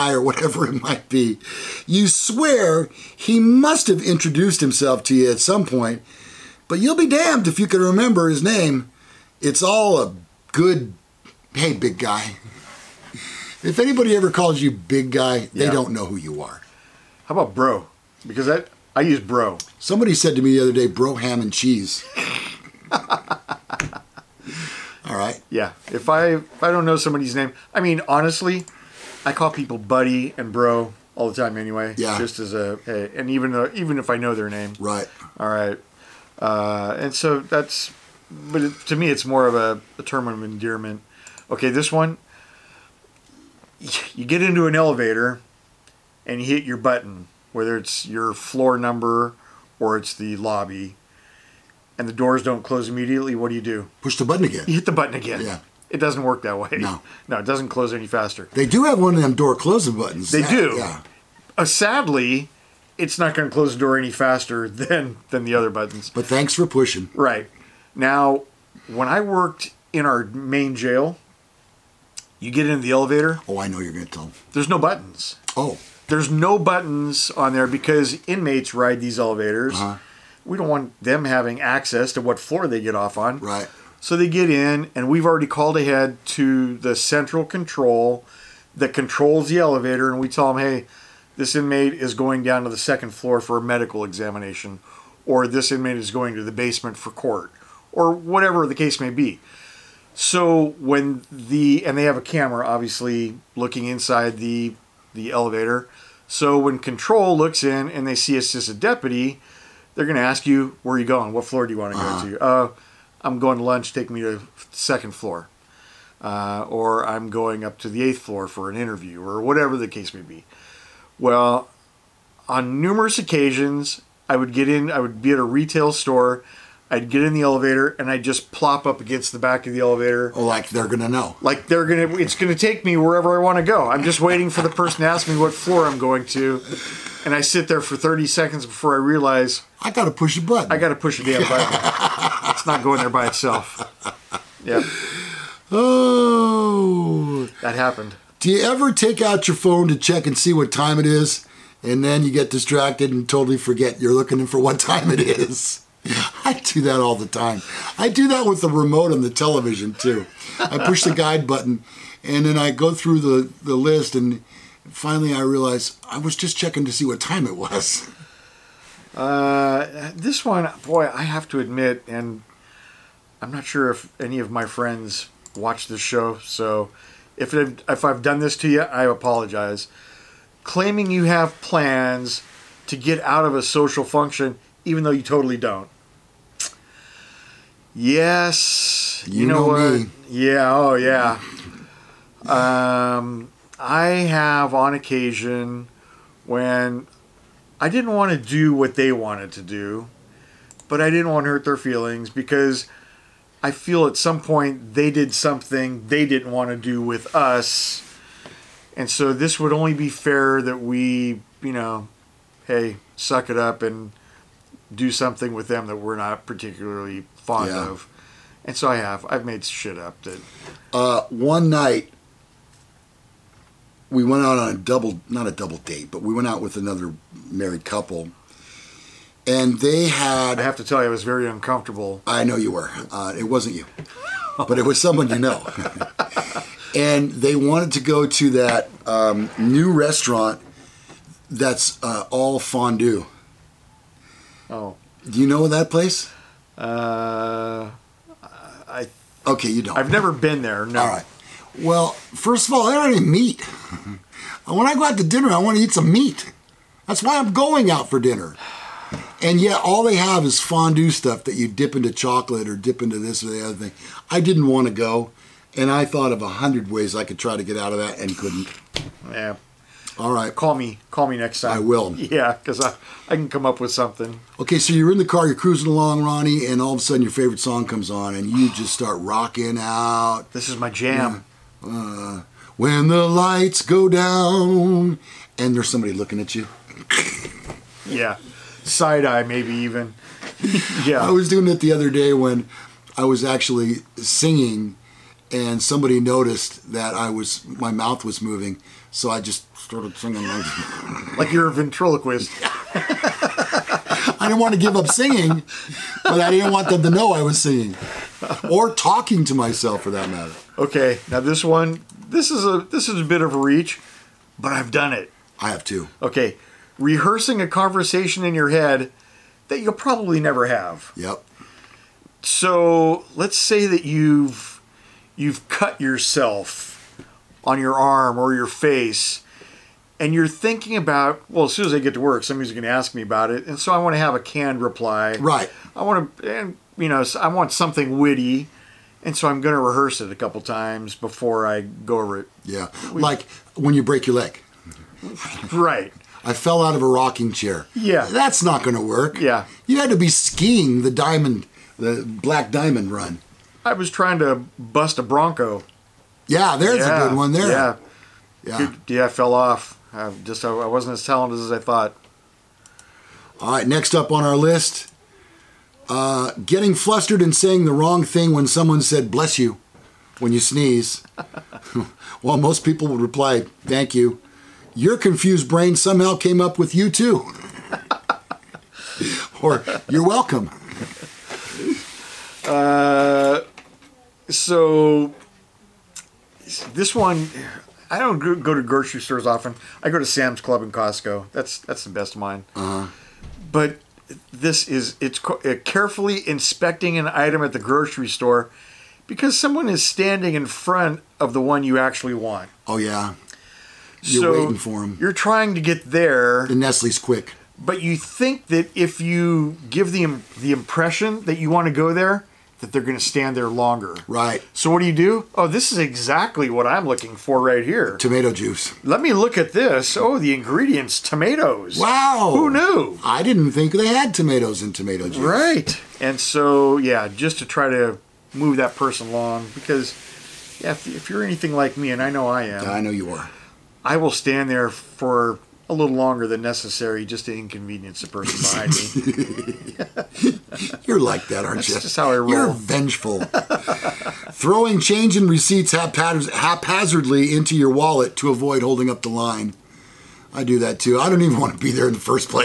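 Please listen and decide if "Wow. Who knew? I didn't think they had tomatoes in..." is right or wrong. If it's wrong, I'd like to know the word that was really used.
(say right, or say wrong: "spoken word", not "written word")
right.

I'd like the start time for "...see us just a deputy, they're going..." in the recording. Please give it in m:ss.
1:48.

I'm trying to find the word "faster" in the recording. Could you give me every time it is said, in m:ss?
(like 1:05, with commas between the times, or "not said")
0:58, 1:04.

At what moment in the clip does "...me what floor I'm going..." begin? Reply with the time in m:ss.
2:15.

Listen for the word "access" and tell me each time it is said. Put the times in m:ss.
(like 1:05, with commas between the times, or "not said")
1:21.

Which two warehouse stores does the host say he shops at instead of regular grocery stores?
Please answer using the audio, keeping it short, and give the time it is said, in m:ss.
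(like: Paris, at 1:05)
Sam's Club and Costco, at 6:30.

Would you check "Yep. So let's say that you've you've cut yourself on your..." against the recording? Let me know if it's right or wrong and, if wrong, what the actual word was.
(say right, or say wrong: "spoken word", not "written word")
right.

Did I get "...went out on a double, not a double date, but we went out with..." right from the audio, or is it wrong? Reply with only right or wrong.
right.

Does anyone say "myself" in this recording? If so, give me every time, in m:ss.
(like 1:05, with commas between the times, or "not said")
5:09.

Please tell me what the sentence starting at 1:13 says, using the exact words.
Oh, I know you're going to tell.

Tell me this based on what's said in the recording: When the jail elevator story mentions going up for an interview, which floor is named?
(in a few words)
eighth floor.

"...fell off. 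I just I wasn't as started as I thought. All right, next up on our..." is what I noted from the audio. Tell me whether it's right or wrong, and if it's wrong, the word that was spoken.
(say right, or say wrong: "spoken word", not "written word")
wrong: "talented", not "started".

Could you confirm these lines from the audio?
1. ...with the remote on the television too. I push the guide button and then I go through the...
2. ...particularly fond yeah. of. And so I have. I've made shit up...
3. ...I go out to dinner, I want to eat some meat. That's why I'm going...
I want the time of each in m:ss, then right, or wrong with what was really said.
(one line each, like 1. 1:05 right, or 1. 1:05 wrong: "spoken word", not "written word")
1. 2:38 right
2. 3:36 right
3. 4:14 right.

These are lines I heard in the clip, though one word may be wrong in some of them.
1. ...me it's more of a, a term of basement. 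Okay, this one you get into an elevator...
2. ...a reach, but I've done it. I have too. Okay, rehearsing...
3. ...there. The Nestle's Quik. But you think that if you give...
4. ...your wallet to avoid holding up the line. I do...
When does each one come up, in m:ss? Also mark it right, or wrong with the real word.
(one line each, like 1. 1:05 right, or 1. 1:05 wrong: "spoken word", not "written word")
1. 0:38 wrong: "endearment", not "basement"
2. 5:13 right
3. 6:46 right
4. 7:27 right.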